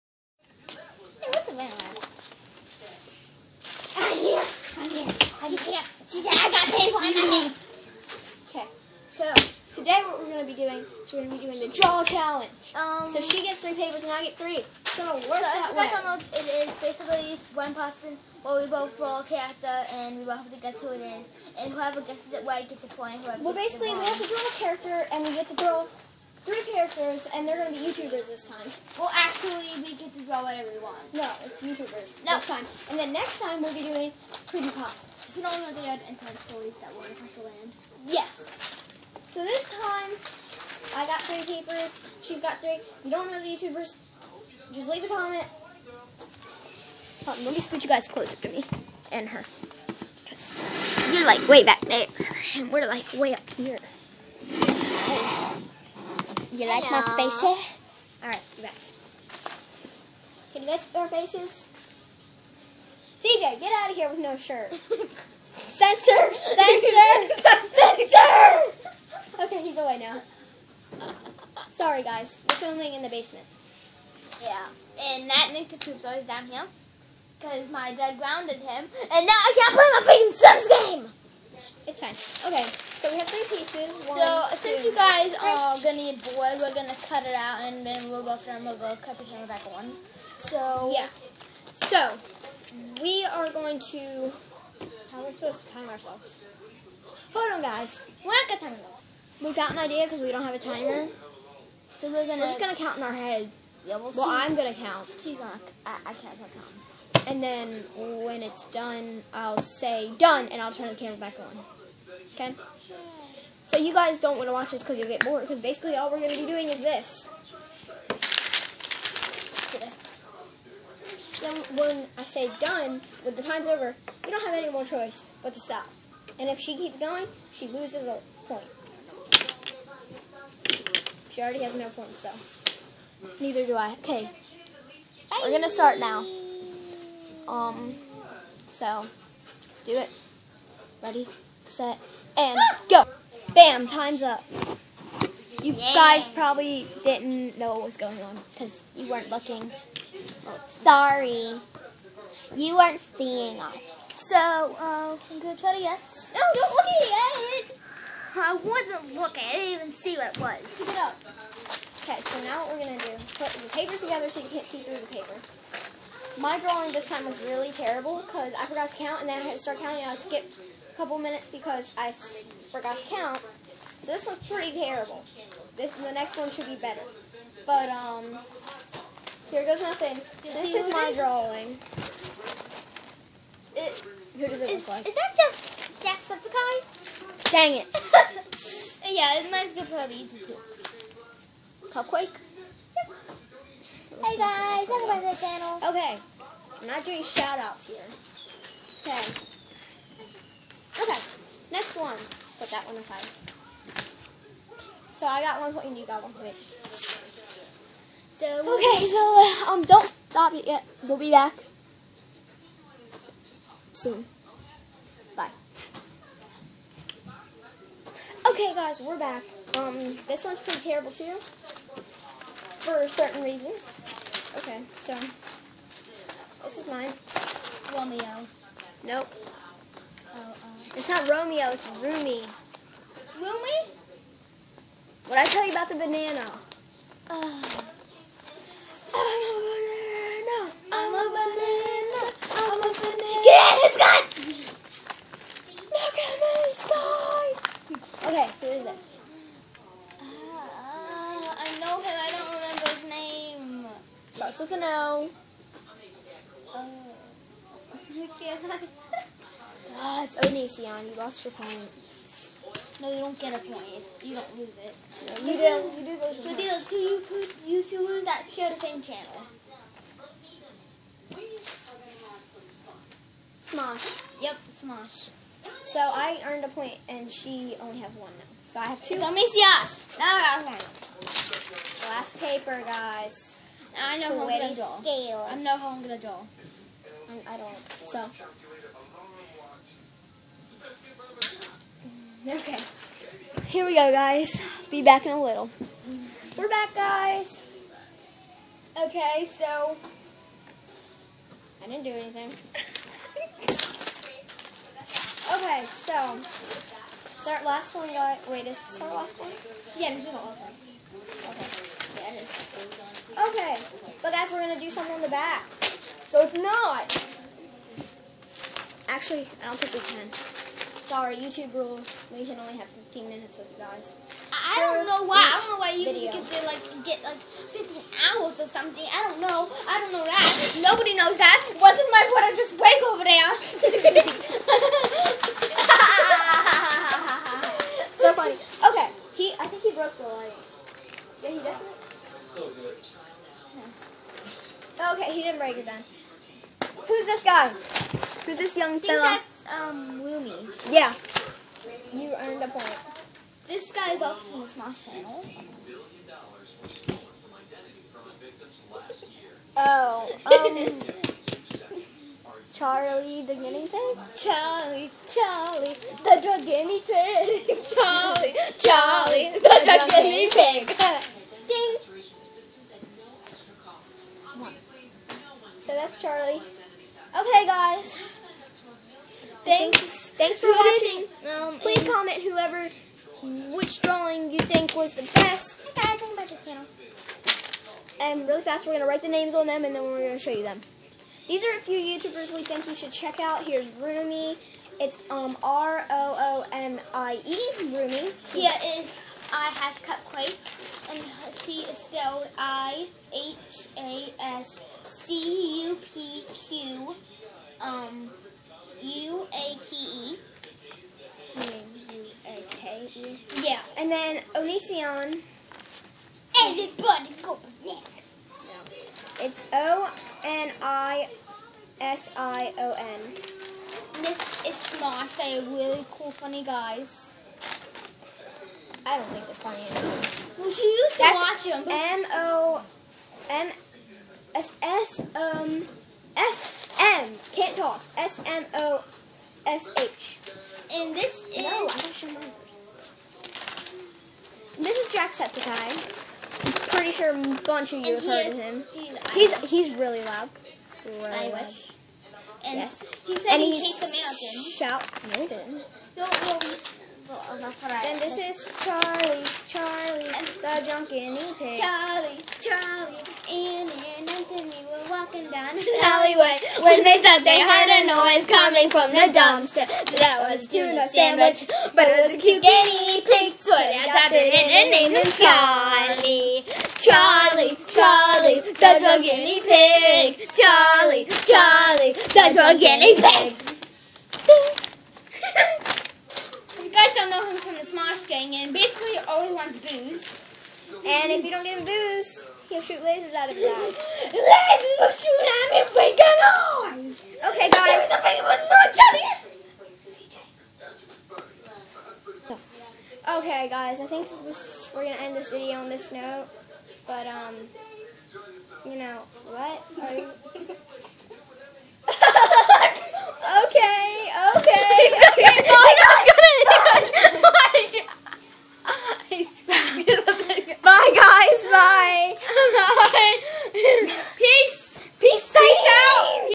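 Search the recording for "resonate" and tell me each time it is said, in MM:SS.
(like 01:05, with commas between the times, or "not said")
not said.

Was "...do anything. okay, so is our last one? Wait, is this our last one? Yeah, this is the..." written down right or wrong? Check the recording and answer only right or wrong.
right.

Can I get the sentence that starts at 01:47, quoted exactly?
And then when it's done, I'll say done and I'll turn the camera back on.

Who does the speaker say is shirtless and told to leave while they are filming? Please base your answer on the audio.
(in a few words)
CJ.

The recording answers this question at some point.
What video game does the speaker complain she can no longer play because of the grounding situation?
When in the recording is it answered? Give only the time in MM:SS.
01:20.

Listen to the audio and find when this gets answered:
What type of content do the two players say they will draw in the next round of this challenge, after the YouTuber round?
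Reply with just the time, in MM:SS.
00:34.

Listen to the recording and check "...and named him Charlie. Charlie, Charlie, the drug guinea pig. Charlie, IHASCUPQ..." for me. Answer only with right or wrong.
wrong.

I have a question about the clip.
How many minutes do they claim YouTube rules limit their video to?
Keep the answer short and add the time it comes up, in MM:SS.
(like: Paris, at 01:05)
15, at 05:22.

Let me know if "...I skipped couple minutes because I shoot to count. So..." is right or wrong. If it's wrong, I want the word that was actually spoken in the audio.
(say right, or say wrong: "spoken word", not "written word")
wrong: "forgot", not "shoot".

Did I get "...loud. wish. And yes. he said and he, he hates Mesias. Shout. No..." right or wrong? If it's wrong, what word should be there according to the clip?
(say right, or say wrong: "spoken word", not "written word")
wrong: "Americans", not "Mesias".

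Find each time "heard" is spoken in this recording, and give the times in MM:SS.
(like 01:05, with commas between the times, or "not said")
07:28, 07:47.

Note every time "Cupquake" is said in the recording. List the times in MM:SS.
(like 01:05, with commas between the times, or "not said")
03:11.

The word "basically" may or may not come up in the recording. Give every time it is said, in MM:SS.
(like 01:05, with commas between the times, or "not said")
00:16, 00:23, 01:55, 08:08.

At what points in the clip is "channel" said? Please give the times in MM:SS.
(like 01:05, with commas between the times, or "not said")
03:15, 04:29, 05:55, 06:26.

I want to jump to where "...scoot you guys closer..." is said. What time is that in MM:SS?
00:47.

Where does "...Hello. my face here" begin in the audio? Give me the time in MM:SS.
00:56.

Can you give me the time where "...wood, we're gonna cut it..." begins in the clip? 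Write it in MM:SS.
01:26.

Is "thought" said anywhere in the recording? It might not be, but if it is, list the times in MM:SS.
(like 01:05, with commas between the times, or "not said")
07:47.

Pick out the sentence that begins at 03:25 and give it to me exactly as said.
So I got one point and you got one point.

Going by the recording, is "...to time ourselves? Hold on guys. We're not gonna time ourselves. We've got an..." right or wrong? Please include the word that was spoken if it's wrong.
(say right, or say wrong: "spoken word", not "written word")
right.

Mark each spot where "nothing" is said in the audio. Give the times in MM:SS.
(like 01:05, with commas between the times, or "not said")
00:07, 02:59.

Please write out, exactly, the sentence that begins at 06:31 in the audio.
These are a few YouTubers we think you should check out.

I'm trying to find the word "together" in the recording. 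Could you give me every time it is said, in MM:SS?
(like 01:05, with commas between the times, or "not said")
02:43.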